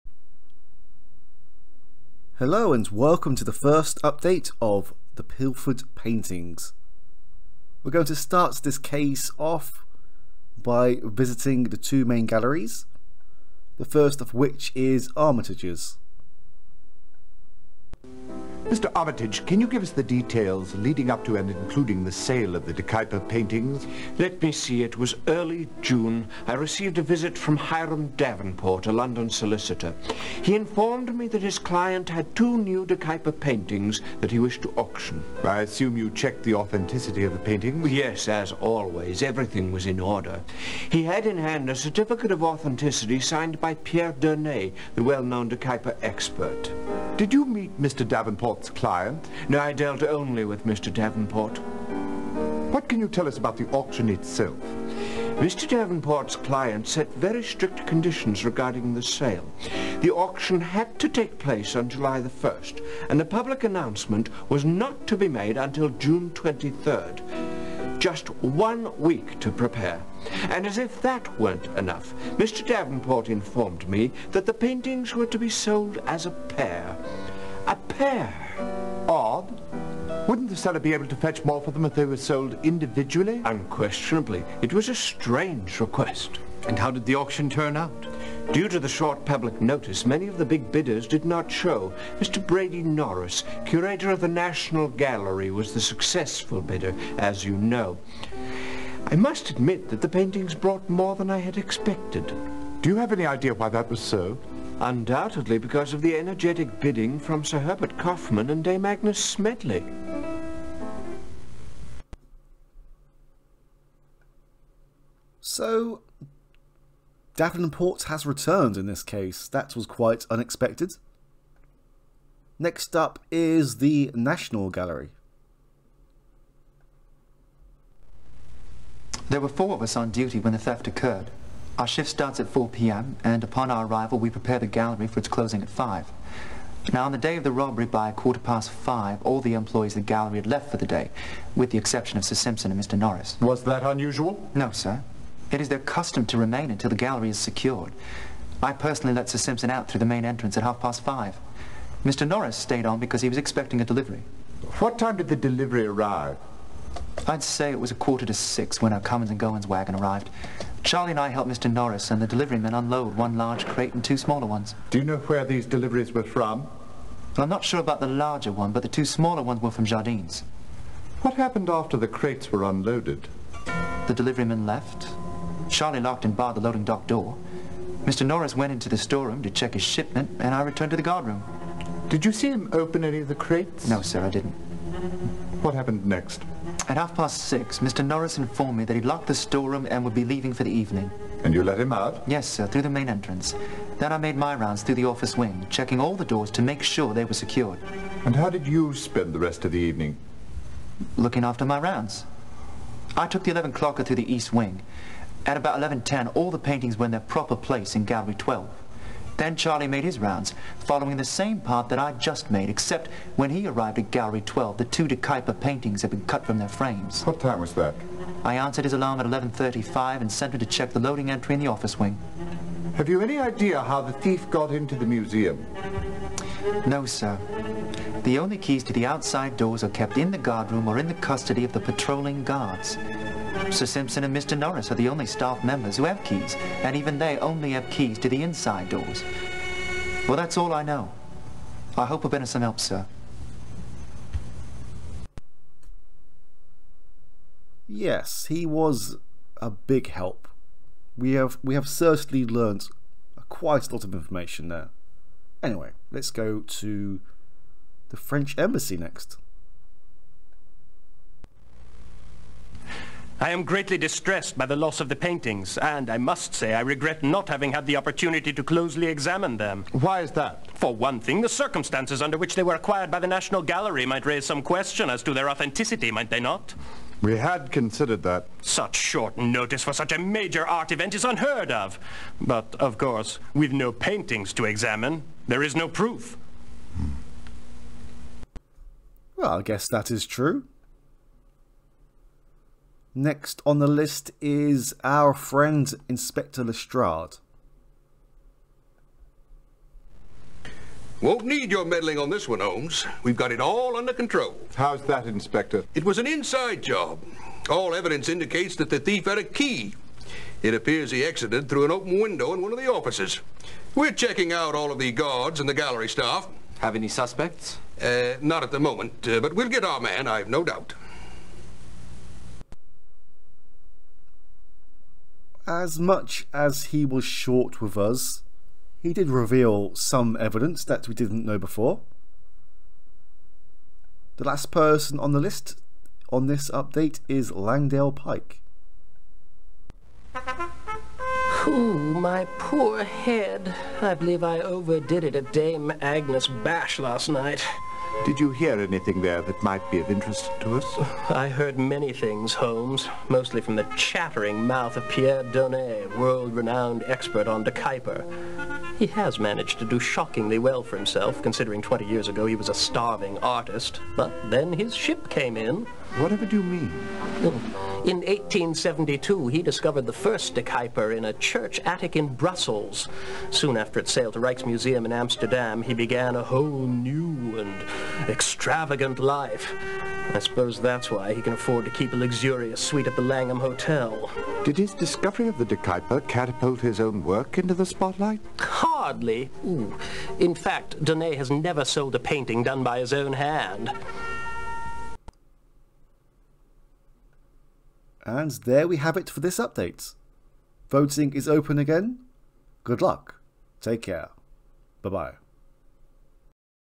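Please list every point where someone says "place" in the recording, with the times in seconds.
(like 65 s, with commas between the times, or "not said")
61 s, 207 s.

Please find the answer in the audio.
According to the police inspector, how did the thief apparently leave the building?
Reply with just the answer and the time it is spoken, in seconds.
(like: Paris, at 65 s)
an open window, at 311 s.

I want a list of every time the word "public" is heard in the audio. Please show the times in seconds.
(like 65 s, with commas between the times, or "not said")
63 s, 89 s.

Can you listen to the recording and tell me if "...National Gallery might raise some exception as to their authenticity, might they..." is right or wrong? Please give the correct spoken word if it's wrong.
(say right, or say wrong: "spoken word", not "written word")
wrong: "question", not "exception".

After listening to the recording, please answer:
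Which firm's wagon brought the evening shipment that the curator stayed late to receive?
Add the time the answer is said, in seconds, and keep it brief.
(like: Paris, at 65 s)
Cummins and Goins, at 159 s.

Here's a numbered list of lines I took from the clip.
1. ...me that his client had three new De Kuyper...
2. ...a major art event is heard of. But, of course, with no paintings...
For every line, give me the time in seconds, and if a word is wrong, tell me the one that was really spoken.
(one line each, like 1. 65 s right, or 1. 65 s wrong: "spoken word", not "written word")
1. 31 s wrong: "two", not "three"
2. 280 s wrong: "unheard", not "heard".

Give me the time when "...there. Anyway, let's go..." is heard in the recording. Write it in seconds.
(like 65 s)
254 s.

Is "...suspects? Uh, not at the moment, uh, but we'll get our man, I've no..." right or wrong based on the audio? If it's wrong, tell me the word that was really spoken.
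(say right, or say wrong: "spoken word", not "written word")
right.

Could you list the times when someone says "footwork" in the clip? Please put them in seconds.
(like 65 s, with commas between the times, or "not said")
not said.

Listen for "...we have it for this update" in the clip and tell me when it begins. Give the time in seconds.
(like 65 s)
398 s.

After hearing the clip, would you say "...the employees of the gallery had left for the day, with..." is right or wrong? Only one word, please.
right.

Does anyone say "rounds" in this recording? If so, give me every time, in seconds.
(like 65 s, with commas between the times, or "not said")
194 s, 201 s, 210 s.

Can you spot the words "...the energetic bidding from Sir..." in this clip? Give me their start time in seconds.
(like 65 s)
106 s.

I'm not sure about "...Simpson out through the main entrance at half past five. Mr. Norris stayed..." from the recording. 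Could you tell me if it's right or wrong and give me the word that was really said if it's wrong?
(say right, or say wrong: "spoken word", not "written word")
right.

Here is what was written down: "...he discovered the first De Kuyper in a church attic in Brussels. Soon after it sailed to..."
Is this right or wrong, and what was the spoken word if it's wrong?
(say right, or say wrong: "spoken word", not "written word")
right.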